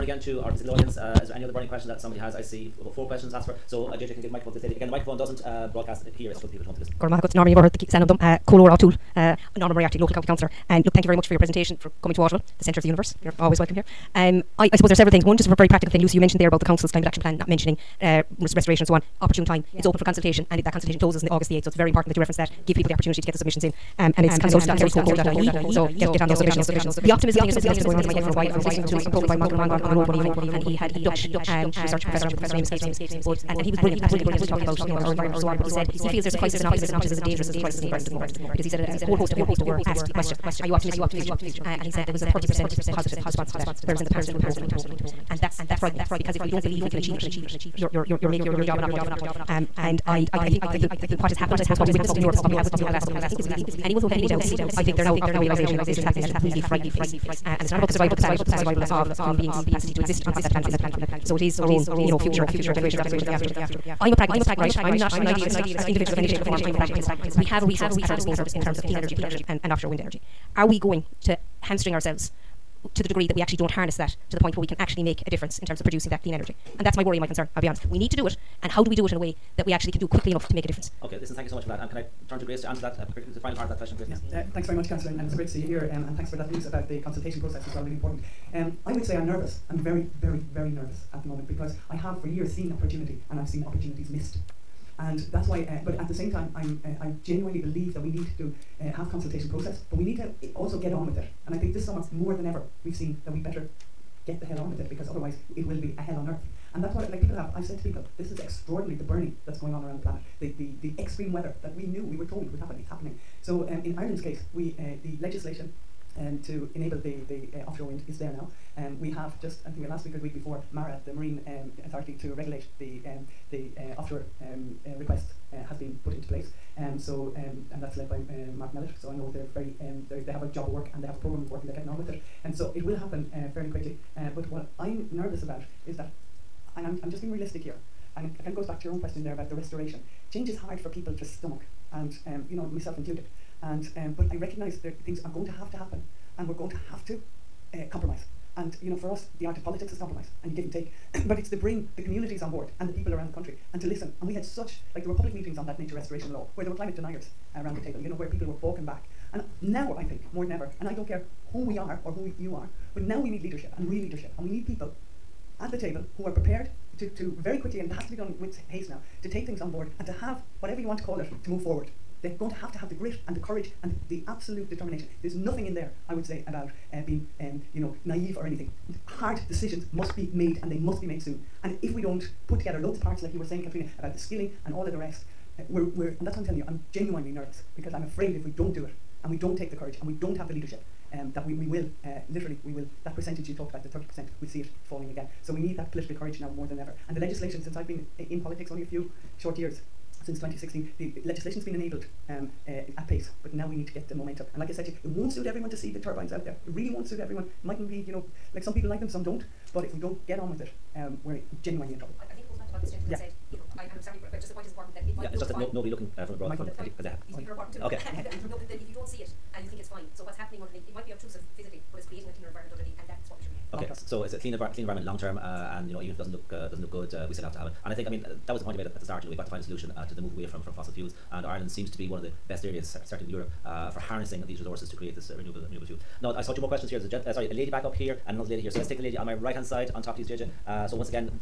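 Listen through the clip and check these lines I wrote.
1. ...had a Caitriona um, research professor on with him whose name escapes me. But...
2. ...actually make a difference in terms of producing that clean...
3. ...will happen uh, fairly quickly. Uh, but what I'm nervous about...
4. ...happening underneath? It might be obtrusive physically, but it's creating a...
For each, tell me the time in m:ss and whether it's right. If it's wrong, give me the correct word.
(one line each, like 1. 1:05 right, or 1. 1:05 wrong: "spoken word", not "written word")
1. 0:30 wrong: "Dutch", not "Caitriona"
2. 1:14 right
3. 2:12 right
4. 3:40 right.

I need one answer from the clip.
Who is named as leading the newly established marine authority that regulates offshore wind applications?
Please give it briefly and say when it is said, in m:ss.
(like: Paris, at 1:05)
Mark Mellett, at 2:08.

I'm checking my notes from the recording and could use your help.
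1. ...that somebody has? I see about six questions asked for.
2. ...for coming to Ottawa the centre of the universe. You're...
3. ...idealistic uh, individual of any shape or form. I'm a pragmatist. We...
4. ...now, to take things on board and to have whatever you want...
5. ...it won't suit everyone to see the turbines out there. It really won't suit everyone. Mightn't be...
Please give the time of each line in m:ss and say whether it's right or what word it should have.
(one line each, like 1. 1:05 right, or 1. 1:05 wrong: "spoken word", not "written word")
1. 0:01 wrong: "four", not "six"
2. 0:11 right
3. 1:05 right
4. 2:48 right
5. 3:25 right.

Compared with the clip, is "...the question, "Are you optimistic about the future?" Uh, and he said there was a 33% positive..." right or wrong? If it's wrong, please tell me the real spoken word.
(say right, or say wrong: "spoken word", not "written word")
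wrong: "30", not "33".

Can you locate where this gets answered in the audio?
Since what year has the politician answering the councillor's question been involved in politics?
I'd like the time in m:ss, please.
3:20.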